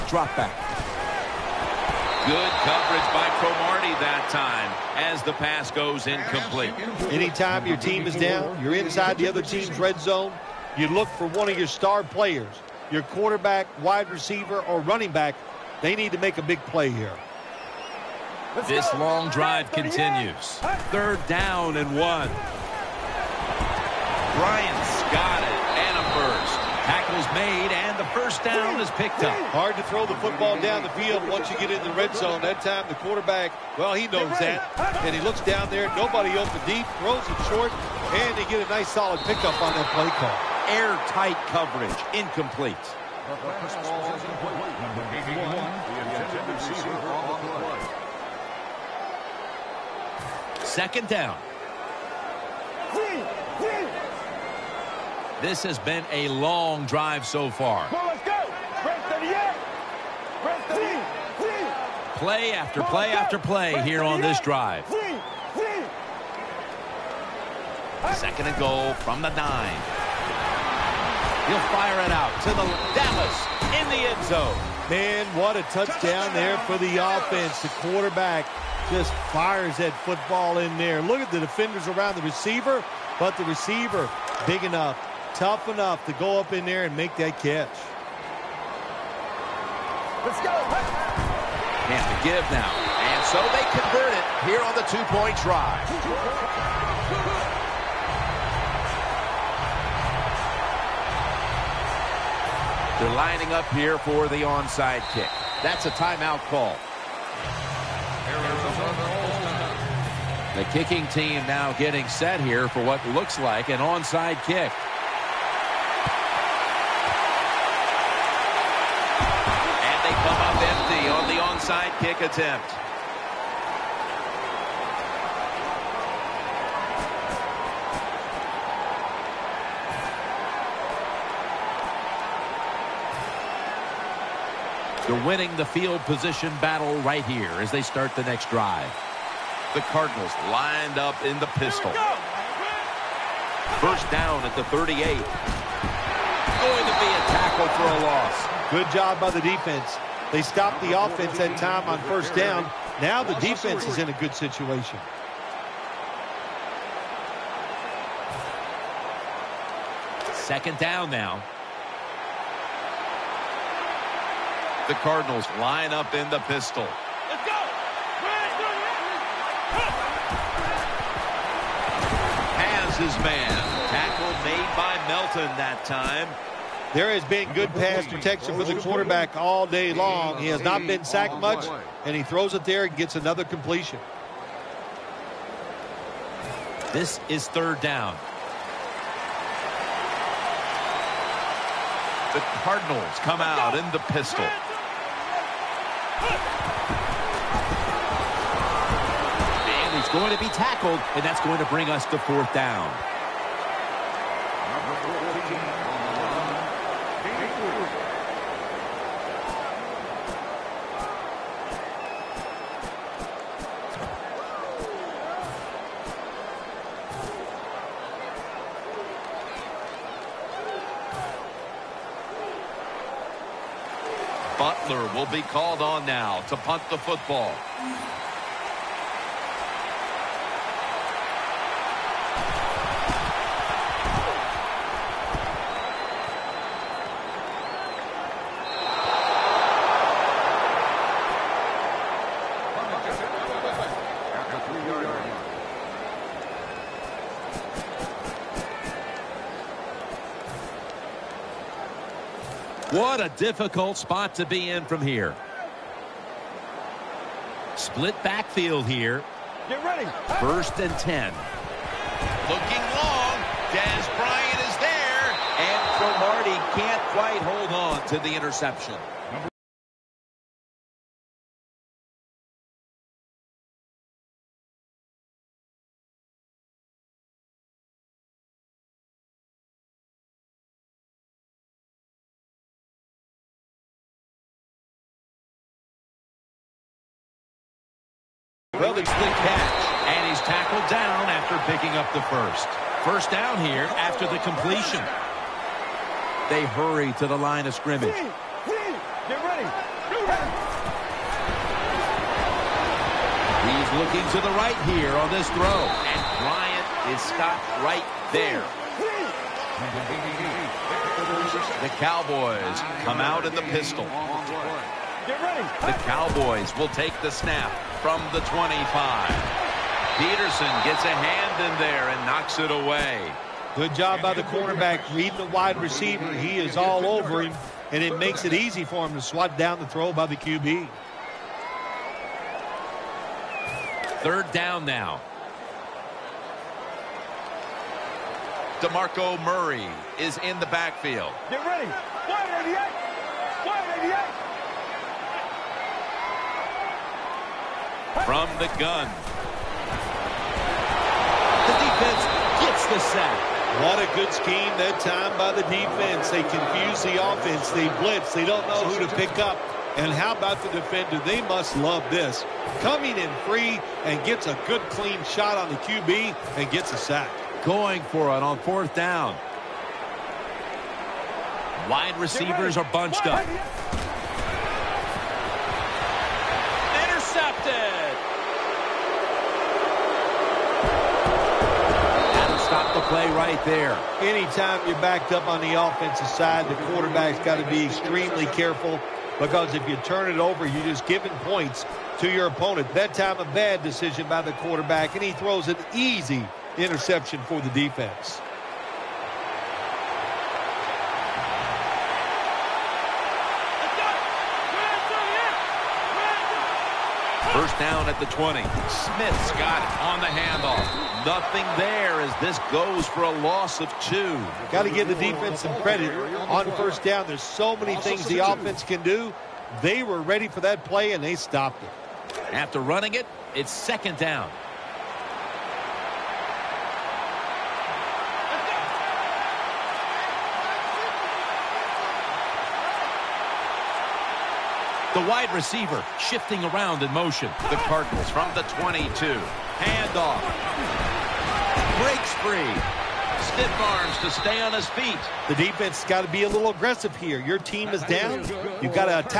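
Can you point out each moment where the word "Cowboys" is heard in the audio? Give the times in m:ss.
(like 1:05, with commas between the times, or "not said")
5:12, 5:16.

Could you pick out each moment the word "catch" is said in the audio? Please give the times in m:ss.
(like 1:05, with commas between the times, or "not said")
1:27, 4:49.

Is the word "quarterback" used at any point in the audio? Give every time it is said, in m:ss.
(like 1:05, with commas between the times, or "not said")
0:13, 0:32, 1:17, 2:58, 6:26, 6:34.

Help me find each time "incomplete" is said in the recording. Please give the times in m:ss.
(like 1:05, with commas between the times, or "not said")
0:06, 0:42.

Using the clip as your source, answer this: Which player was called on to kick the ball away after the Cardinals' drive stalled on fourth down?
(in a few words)
Butler.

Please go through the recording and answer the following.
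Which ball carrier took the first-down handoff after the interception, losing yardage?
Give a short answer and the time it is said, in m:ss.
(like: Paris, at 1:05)
Smith, at 6:48.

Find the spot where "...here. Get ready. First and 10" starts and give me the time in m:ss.
4:18.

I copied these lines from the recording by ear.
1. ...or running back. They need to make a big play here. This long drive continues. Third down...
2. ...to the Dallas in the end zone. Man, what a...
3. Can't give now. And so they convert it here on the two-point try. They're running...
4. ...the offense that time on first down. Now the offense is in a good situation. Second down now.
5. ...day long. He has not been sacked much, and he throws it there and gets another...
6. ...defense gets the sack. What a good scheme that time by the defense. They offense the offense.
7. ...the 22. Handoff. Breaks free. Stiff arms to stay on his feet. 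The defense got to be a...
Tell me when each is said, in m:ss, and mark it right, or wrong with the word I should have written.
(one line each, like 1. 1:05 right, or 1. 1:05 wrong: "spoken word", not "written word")
1. 0:14 right
2. 1:12 right
3. 1:31 wrong: "lining", not "running"
4. 2:30 wrong: "defense", not "offense"
5. 2:59 right
6. 5:51 wrong: "confuse", not "offense"
7. 7:18 right.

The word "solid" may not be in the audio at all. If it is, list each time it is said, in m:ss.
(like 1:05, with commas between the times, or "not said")
0:38.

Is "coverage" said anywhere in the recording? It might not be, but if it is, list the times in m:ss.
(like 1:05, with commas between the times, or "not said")
0:02, 0:41.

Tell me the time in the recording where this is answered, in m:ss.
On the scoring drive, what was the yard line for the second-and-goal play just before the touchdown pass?
1:08.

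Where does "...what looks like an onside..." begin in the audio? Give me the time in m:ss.
1:52.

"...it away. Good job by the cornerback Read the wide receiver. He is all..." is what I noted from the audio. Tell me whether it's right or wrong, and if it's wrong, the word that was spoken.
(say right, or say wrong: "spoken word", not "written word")
right.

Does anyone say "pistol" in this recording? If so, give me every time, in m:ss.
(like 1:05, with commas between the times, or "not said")
2:21, 2:46, 3:14, 5:13.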